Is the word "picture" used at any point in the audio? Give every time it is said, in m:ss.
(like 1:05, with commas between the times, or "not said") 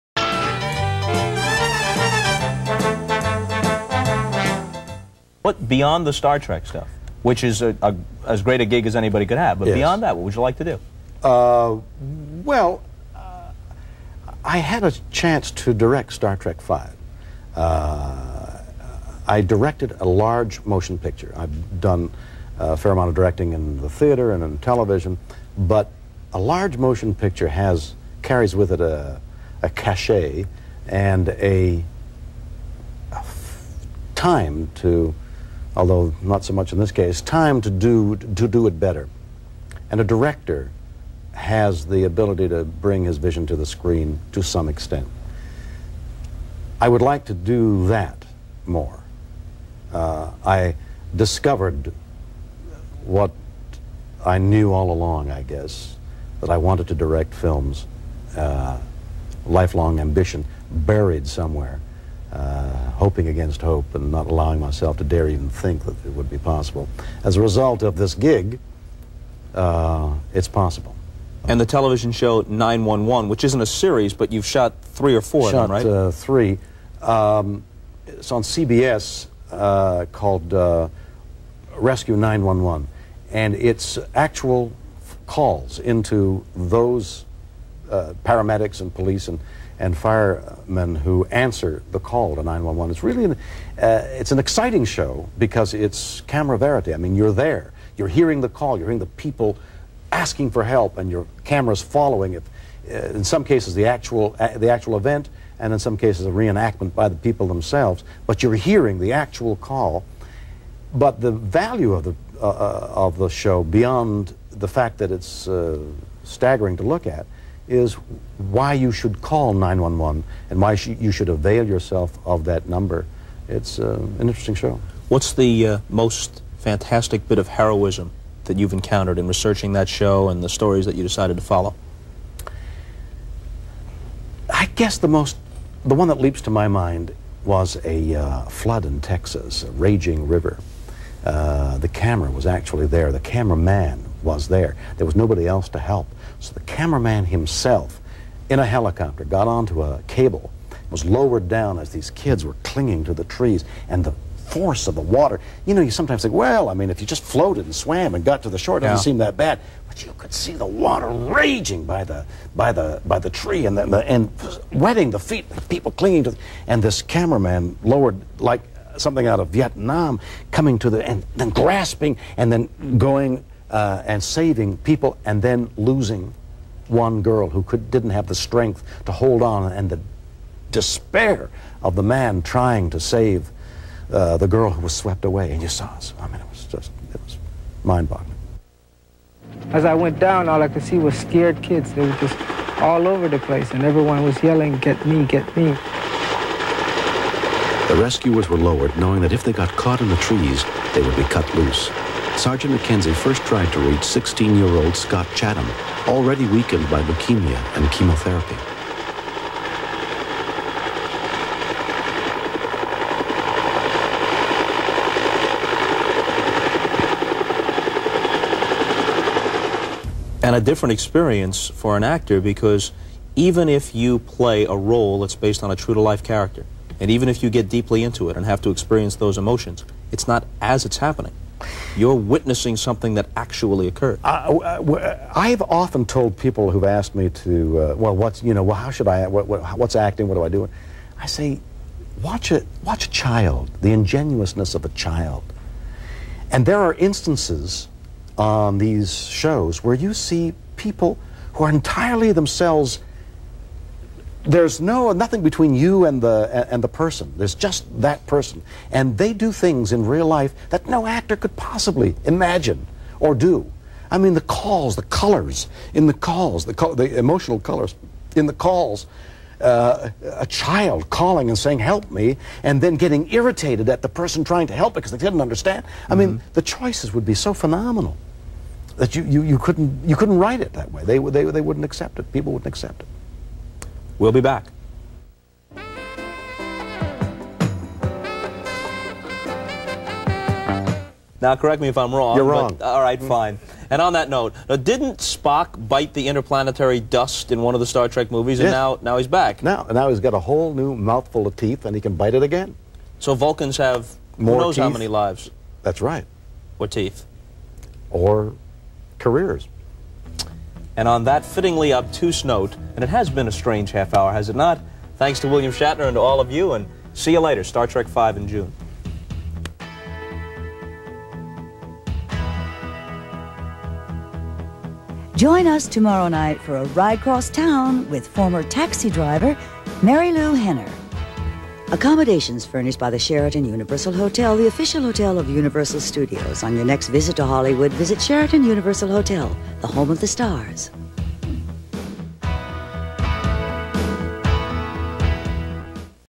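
0:20, 0:27.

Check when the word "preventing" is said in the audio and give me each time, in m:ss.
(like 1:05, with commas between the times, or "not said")
not said.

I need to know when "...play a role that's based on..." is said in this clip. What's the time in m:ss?
3:44.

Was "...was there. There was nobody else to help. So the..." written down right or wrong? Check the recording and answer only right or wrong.
right.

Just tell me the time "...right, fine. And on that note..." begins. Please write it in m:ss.
4:53.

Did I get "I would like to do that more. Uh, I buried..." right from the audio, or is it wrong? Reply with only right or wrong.
wrong.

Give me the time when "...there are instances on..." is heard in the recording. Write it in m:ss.
4:06.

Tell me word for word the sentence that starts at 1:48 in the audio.
But you're hearing the actual call.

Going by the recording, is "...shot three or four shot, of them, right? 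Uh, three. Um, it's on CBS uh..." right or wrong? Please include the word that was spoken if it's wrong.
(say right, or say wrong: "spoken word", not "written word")
right.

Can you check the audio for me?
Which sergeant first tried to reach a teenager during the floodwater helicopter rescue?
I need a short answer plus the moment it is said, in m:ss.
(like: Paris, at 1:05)
McKenzie, at 3:22.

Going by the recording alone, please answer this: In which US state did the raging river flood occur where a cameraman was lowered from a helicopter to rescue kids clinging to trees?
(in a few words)
Texas.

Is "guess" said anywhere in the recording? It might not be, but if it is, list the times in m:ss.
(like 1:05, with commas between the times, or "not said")
0:55, 2:14.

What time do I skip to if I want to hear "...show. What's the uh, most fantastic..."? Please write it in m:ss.
2:04.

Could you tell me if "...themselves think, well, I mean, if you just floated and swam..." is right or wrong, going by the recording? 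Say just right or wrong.
wrong.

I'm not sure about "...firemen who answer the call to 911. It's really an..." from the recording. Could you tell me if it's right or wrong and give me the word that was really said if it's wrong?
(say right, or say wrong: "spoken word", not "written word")
right.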